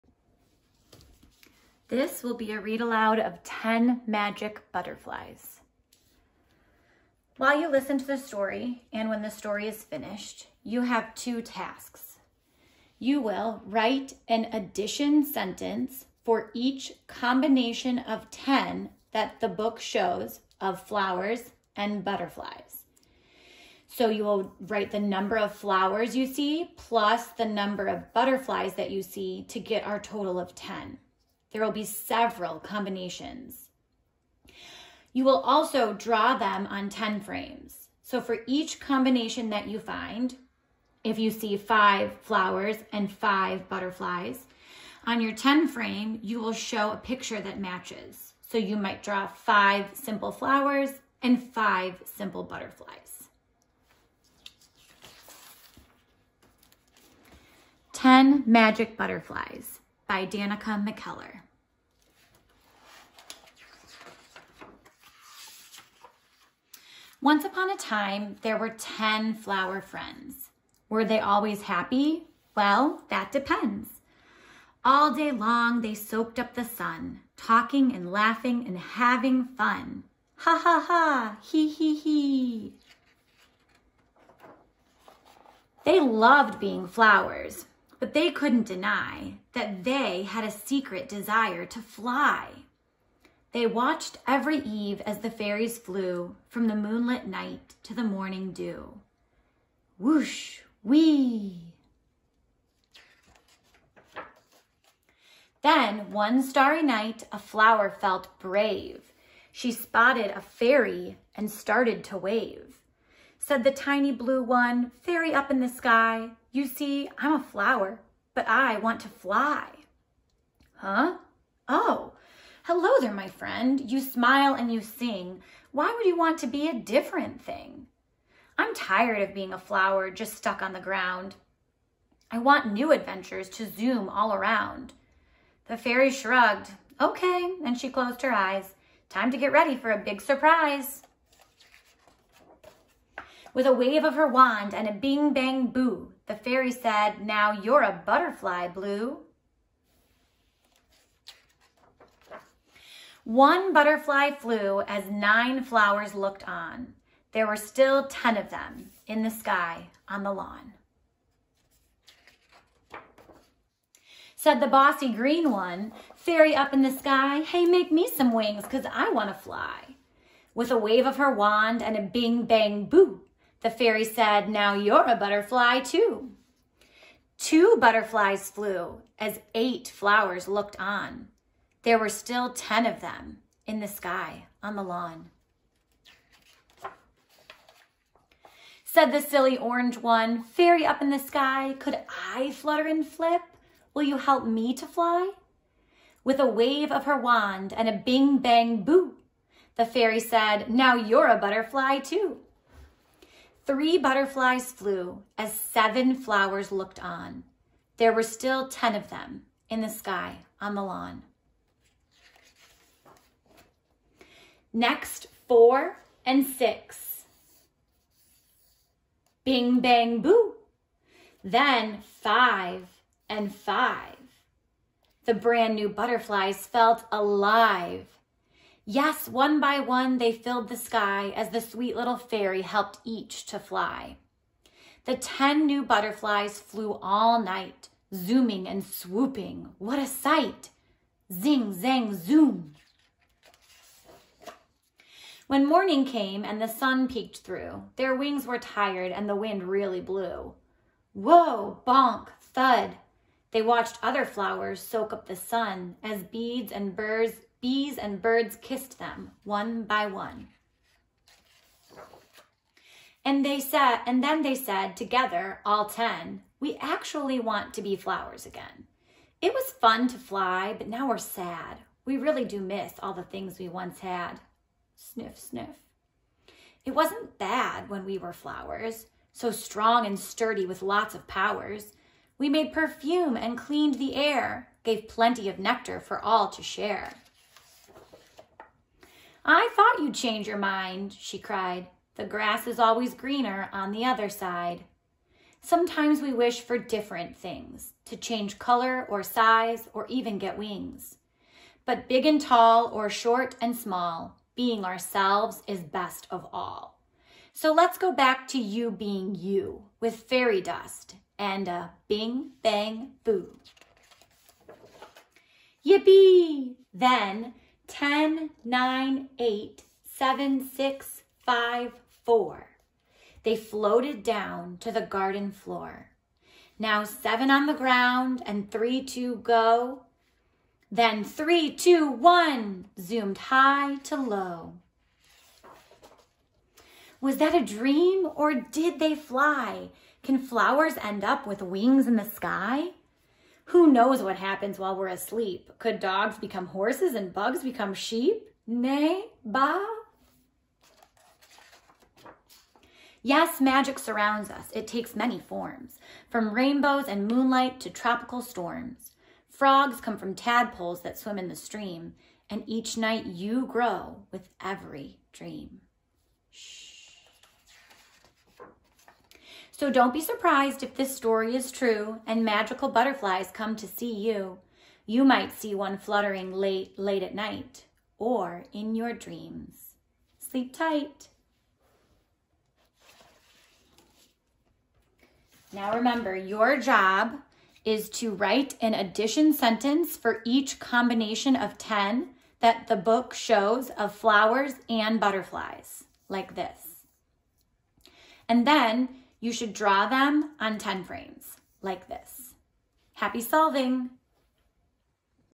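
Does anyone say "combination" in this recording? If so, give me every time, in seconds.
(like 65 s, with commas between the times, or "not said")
17 s, 32 s, 38 s, 390 s.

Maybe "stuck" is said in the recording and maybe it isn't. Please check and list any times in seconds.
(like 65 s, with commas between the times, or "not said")
130 s.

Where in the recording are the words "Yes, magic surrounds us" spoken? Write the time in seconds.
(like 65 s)
353 s.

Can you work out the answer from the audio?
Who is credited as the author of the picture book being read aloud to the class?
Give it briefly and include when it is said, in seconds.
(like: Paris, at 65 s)
Danica McKellar, at 60 s.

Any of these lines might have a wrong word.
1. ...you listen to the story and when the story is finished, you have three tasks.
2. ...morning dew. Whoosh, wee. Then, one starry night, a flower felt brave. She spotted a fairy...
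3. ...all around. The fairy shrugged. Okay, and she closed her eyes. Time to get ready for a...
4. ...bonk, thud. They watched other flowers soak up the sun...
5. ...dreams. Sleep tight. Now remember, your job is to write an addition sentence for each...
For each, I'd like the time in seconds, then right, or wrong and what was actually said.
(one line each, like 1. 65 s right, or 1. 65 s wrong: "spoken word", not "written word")
1. 7 s wrong: "two", not "three"
2. 98 s right
3. 134 s right
4. 251 s right
5. 379 s right.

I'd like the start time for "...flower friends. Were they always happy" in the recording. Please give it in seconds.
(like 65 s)
69 s.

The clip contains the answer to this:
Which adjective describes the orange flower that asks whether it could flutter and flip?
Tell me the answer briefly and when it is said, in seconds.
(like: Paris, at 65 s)
Silly, at 189 s.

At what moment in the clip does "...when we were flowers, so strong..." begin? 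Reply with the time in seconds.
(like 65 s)
277 s.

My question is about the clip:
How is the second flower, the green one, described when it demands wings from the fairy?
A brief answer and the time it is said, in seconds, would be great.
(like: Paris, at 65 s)
Bossy, at 164 s.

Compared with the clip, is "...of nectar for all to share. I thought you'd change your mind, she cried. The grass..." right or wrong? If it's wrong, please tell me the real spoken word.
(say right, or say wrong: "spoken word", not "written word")
right.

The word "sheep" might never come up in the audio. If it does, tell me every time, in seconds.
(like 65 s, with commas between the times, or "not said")
347 s.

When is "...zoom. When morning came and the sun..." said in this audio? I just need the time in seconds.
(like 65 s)
242 s.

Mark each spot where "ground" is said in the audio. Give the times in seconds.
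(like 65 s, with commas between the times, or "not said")
130 s, 327 s.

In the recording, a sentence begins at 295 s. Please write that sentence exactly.
Sometimes we wish for different things, to change color or size or even get wings.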